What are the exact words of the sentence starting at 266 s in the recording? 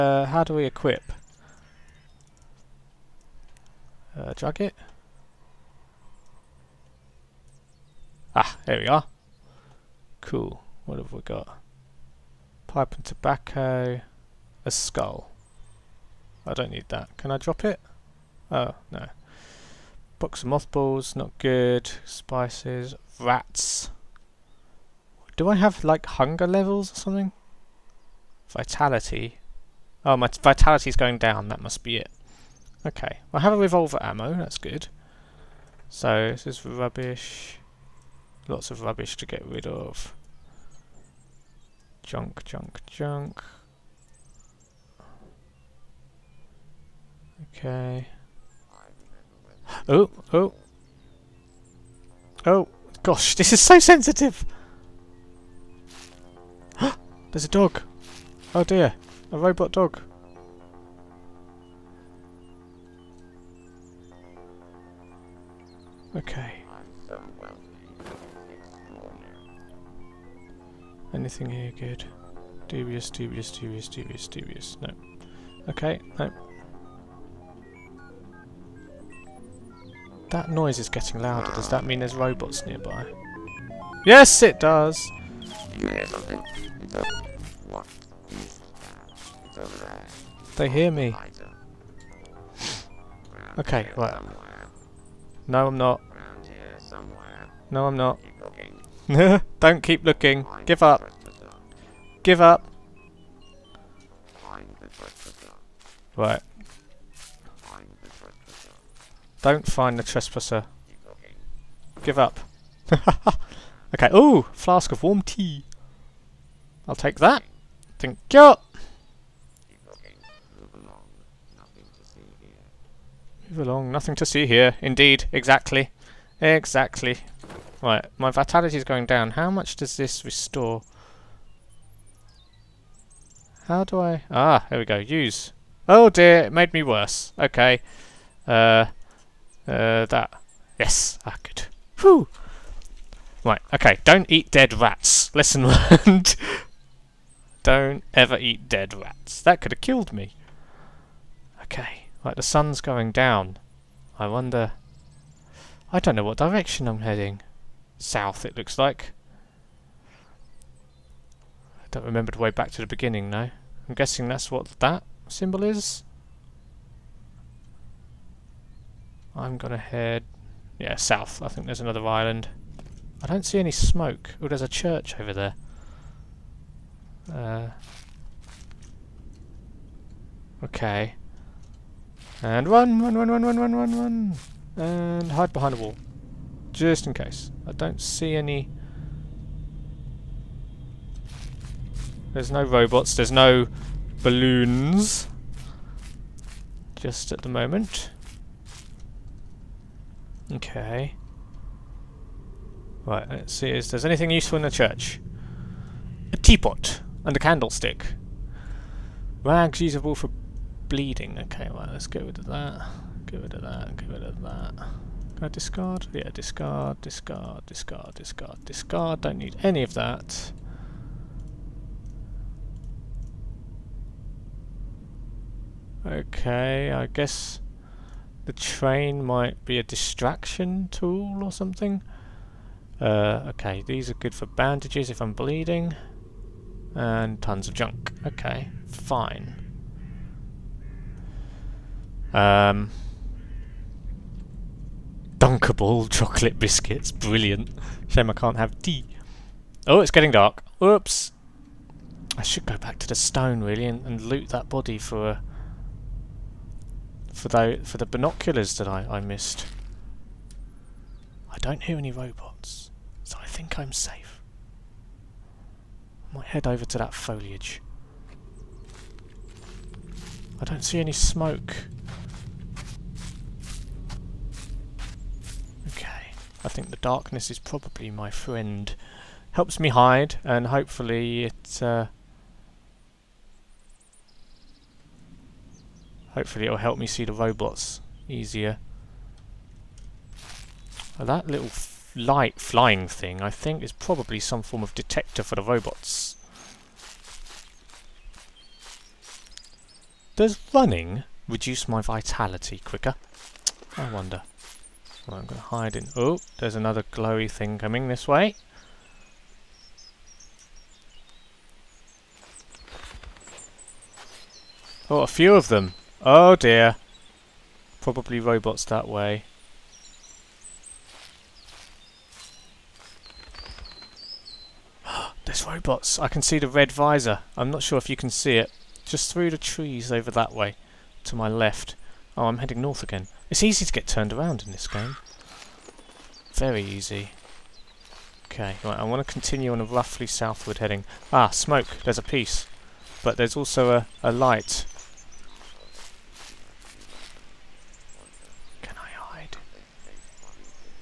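I might head over to that foliage.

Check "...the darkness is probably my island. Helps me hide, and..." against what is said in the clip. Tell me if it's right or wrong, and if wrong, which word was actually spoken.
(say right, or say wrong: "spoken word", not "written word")
wrong: "friend", not "island".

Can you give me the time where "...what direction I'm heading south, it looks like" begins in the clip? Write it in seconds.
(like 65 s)
156 s.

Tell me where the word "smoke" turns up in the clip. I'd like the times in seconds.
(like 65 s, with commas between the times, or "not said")
173 s, 271 s, 341 s.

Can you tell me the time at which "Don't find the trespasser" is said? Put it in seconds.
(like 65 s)
109 s.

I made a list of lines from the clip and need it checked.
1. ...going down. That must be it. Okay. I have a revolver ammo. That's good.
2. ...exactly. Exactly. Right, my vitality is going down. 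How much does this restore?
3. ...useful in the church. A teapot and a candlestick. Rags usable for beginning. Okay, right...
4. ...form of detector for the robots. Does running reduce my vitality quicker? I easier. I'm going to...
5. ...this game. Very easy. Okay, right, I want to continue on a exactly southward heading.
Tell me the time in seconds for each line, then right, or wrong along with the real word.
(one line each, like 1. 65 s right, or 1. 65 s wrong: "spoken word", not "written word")
1. 30 s right
2. 125 s right
3. 204 s wrong: "bleeding", not "beginning"
4. 294 s wrong: "wonder", not "easier"
5. 334 s wrong: "roughly", not "exactly".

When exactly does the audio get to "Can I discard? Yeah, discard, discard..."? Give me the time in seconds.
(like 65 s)
215 s.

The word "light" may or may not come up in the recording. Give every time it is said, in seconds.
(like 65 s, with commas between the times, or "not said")
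292 s, 344 s.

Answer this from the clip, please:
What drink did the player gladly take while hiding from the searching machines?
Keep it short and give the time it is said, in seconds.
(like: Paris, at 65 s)
Flask of warm tea, at 114 s.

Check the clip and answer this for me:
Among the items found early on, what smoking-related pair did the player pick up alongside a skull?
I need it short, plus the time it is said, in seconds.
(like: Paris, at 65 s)
Pipe and tobacco, at 12 s.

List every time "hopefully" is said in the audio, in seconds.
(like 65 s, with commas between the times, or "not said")
280 s, 286 s.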